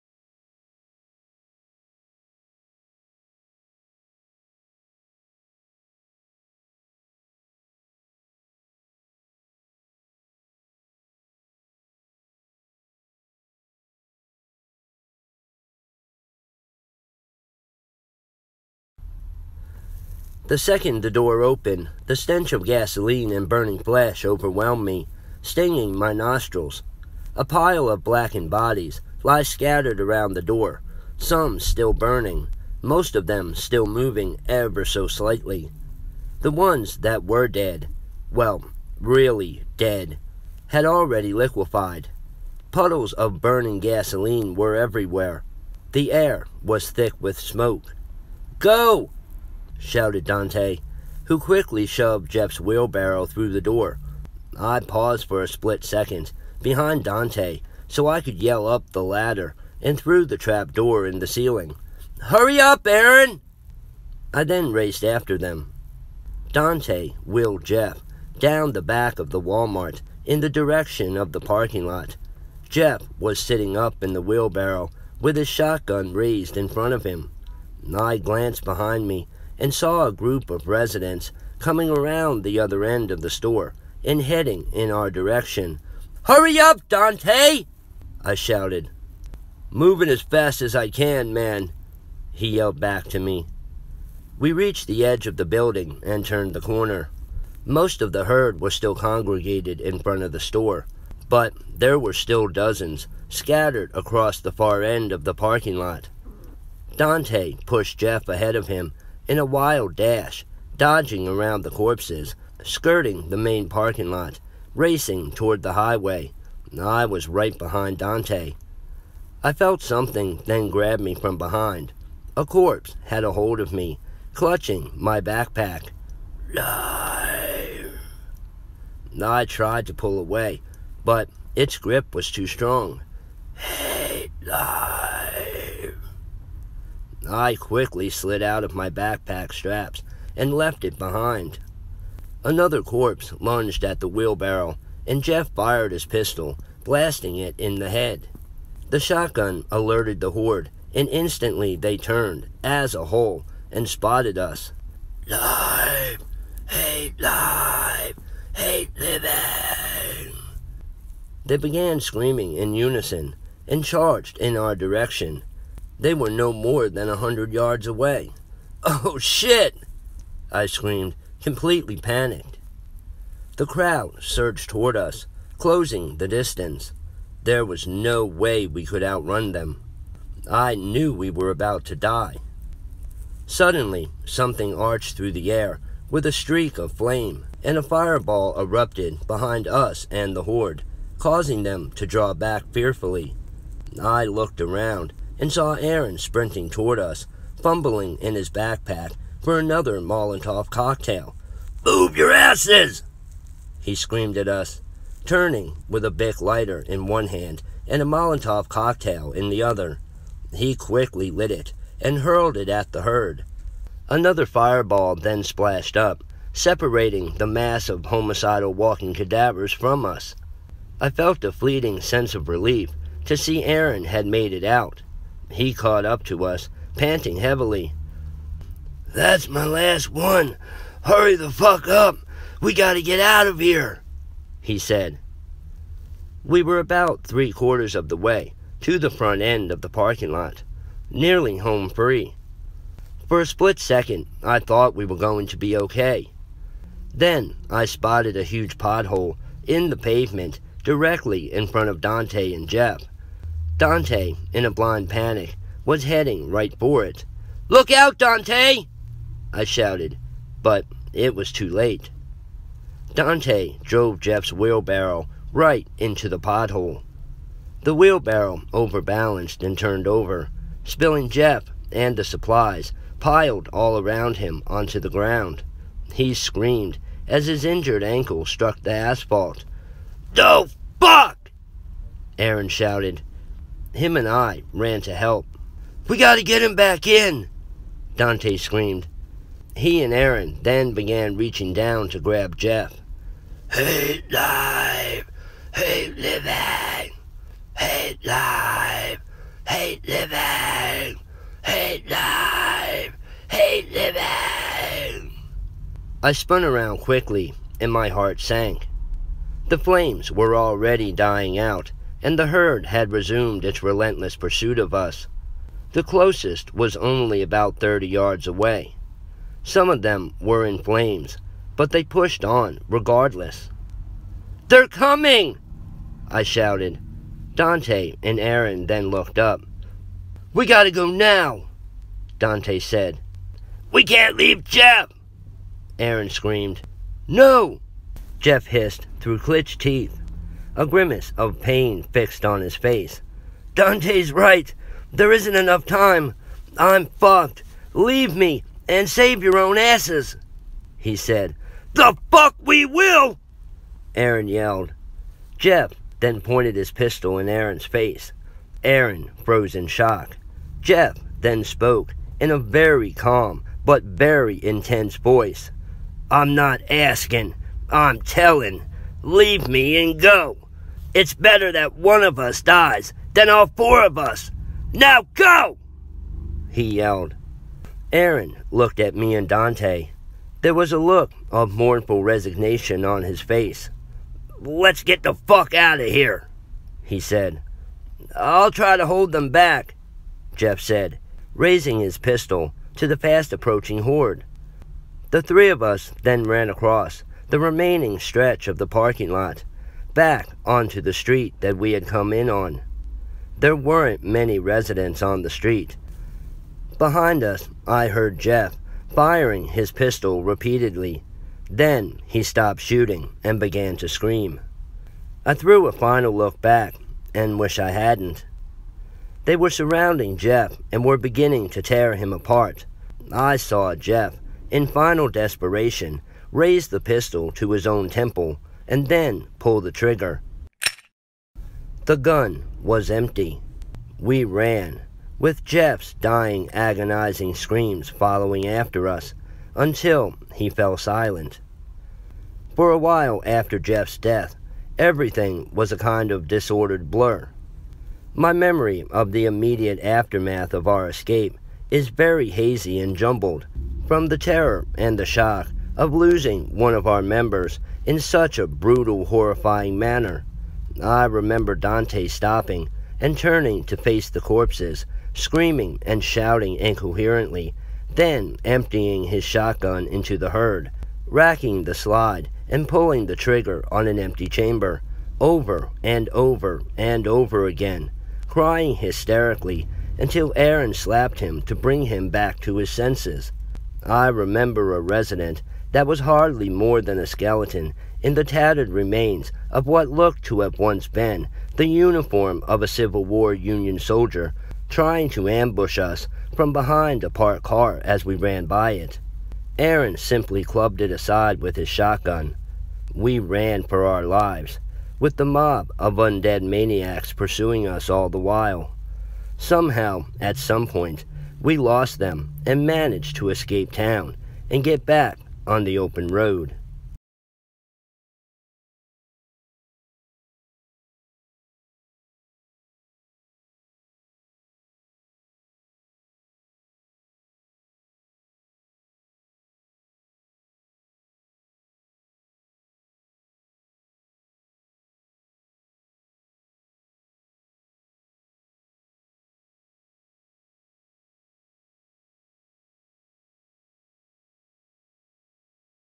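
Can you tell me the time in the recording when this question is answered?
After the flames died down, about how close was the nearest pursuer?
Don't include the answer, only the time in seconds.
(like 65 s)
317 s.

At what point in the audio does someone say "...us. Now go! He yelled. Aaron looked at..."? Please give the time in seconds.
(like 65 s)
374 s.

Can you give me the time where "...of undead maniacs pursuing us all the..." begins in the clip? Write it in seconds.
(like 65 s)
505 s.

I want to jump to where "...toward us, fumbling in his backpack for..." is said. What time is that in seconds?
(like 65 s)
196 s.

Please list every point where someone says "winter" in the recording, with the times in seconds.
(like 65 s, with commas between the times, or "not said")
not said.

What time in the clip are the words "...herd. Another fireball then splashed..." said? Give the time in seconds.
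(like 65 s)
213 s.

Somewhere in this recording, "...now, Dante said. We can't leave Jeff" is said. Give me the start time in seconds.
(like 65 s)
331 s.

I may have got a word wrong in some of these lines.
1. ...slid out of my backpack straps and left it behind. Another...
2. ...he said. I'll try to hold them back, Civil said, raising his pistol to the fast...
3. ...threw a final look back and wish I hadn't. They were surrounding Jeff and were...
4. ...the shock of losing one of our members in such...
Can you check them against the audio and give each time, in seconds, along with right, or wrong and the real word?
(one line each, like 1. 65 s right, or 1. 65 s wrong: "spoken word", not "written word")
1. 138 s right
2. 387 s wrong: "Jeff", not "Civil"
3. 415 s right
4. 455 s right.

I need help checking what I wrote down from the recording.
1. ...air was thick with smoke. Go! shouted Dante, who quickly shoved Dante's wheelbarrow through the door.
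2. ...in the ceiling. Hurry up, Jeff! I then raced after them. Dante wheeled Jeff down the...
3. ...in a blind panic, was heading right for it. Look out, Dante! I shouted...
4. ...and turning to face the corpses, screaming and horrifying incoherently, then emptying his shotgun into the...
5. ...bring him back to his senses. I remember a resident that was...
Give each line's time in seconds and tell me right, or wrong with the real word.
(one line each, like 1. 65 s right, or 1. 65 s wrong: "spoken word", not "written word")
1. 46 s wrong: "Jeff", not "Dante"
2. 61 s wrong: "Aaron", not "Jeff"
3. 254 s right
4. 463 s wrong: "shouting", not "horrifying"
5. 481 s right.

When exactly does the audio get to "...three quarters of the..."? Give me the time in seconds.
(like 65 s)
237 s.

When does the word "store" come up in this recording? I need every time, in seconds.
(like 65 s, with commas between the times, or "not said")
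83 s, 100 s.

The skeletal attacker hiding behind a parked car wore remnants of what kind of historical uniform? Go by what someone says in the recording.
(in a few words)
Civil War Union soldier.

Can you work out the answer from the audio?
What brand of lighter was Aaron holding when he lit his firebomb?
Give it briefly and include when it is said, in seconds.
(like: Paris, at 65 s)
Bic, at 206 s.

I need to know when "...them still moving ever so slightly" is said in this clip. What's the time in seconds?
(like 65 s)
33 s.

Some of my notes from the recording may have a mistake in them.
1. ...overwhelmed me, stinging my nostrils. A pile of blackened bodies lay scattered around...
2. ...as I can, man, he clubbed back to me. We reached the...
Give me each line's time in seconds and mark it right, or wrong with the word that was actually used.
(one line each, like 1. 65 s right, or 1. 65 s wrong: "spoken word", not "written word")
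1. 24 s right
2. 90 s wrong: "yelled", not "clubbed".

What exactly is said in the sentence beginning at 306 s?
I spun around quickly and my heart sank.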